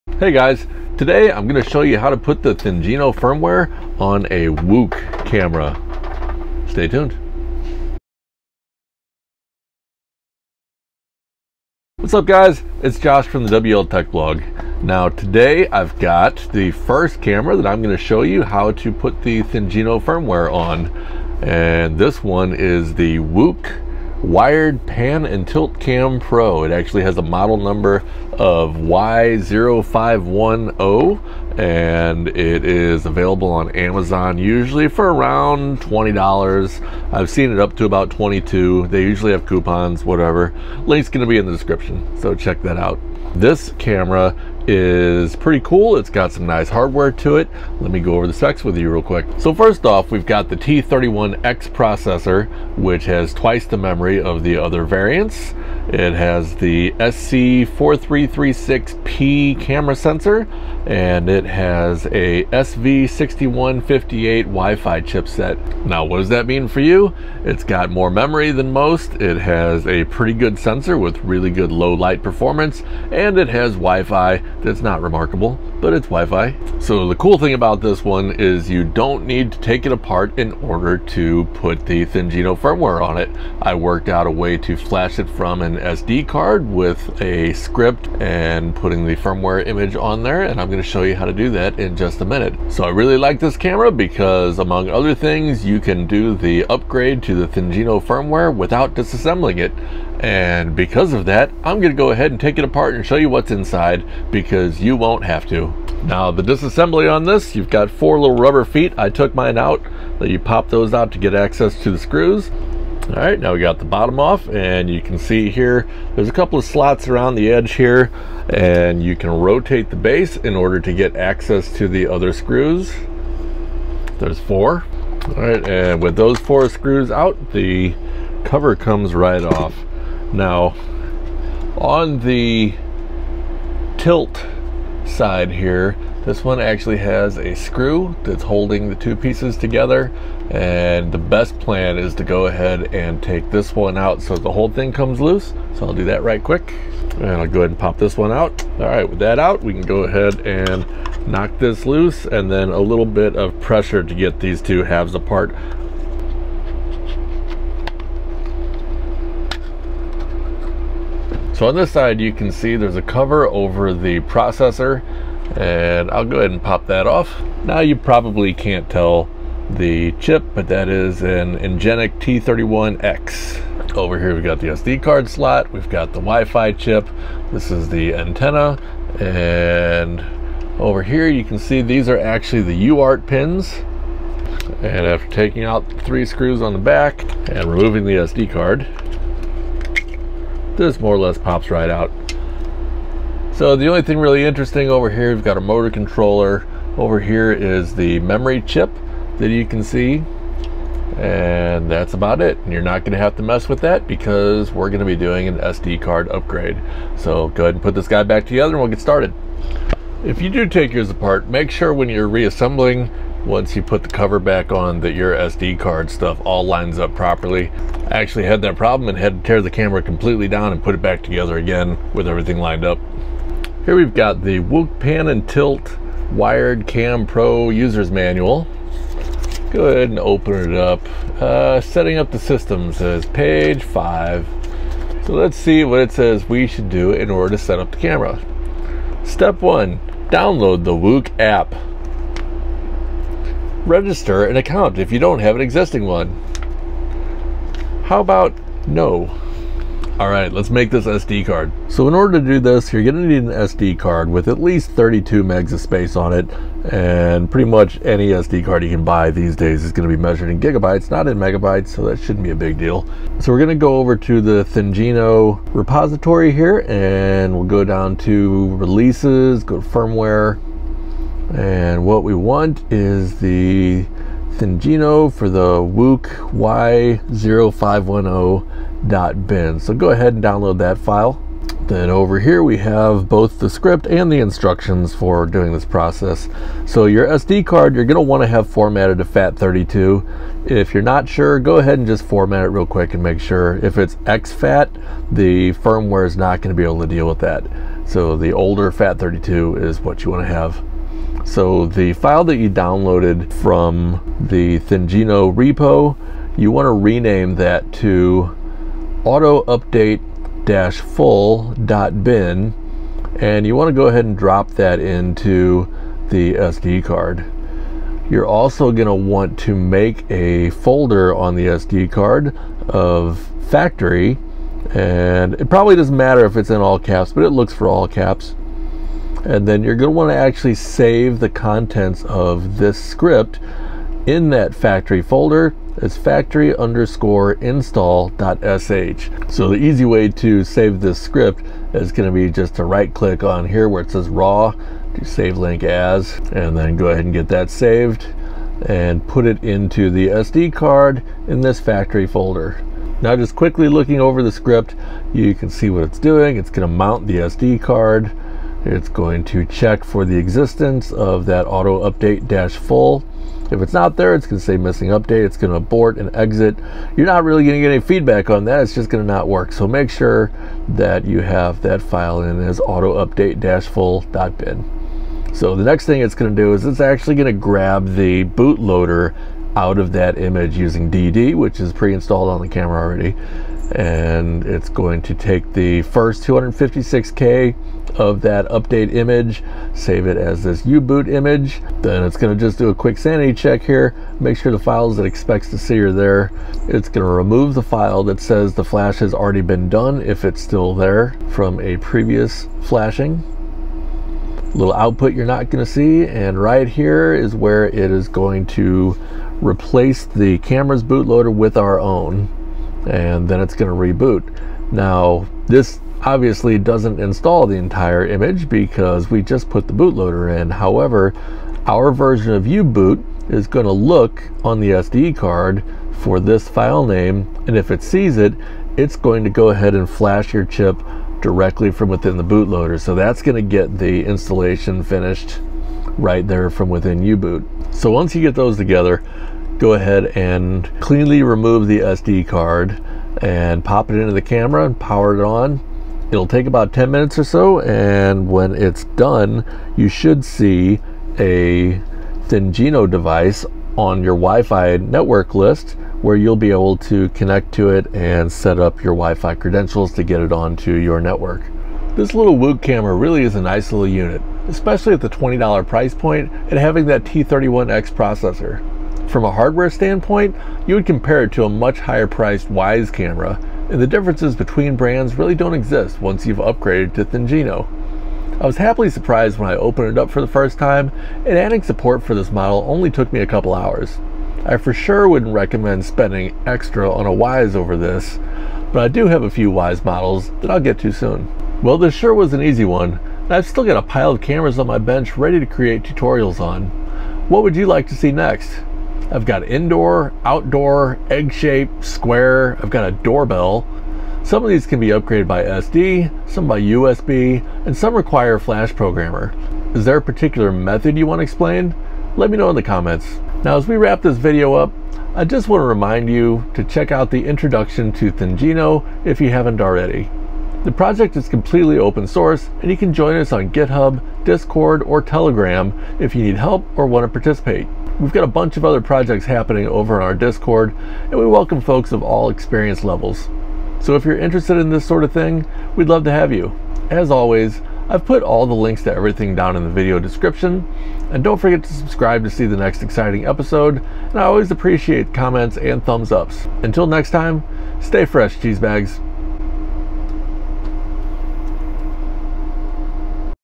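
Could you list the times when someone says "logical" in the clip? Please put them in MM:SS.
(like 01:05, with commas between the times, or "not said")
not said.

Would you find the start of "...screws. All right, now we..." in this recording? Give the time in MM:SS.
01:51.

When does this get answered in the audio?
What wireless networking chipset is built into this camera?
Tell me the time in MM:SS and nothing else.
01:02.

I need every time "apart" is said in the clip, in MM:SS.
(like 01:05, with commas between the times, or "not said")
01:19, 01:42, 02:35, 03:31.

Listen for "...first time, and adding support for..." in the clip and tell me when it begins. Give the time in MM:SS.
08:00.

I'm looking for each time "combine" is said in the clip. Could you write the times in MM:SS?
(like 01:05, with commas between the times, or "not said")
not said.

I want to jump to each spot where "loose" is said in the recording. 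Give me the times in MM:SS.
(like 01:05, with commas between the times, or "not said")
02:25, 02:31.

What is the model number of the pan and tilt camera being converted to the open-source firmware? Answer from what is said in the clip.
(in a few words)
Y0510.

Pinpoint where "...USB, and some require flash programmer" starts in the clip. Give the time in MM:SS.
08:26.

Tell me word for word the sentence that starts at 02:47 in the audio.
Now you probably can't tell the chip, but that is an Ingenic T31X.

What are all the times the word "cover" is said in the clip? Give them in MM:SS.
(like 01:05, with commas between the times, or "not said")
02:08, 02:43, 03:34.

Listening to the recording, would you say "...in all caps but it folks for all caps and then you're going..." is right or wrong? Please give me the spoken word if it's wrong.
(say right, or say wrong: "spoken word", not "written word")
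wrong: "looks", not "folks".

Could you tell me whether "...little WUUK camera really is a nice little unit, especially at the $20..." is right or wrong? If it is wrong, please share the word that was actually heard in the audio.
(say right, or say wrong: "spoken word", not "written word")
right.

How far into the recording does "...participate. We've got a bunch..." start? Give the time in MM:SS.
08:47.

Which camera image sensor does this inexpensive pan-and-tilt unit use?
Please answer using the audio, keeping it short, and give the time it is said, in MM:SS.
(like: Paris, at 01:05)
SC4336P, at 00:56.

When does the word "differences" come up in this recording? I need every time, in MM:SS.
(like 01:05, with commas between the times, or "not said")
07:54.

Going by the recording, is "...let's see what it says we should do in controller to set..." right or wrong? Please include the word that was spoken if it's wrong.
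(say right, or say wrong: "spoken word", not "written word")
wrong: "order", not "controller".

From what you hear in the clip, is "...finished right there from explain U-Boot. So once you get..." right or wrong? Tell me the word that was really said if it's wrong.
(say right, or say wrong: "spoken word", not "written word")
wrong: "within", not "explain".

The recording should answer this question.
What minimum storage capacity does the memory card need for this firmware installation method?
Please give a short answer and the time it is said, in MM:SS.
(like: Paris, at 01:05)
32 MB, at 04:14.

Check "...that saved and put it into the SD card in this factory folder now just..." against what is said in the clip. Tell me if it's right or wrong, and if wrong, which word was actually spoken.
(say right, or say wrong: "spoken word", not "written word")
right.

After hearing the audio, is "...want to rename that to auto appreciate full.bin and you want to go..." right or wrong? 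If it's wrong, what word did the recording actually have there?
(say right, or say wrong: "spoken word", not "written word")
wrong: "update", not "appreciate".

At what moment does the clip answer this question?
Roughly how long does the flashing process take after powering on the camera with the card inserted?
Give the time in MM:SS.
07:26.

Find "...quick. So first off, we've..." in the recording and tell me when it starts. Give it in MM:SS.
00:49.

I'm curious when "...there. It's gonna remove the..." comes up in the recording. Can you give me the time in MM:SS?
06:36.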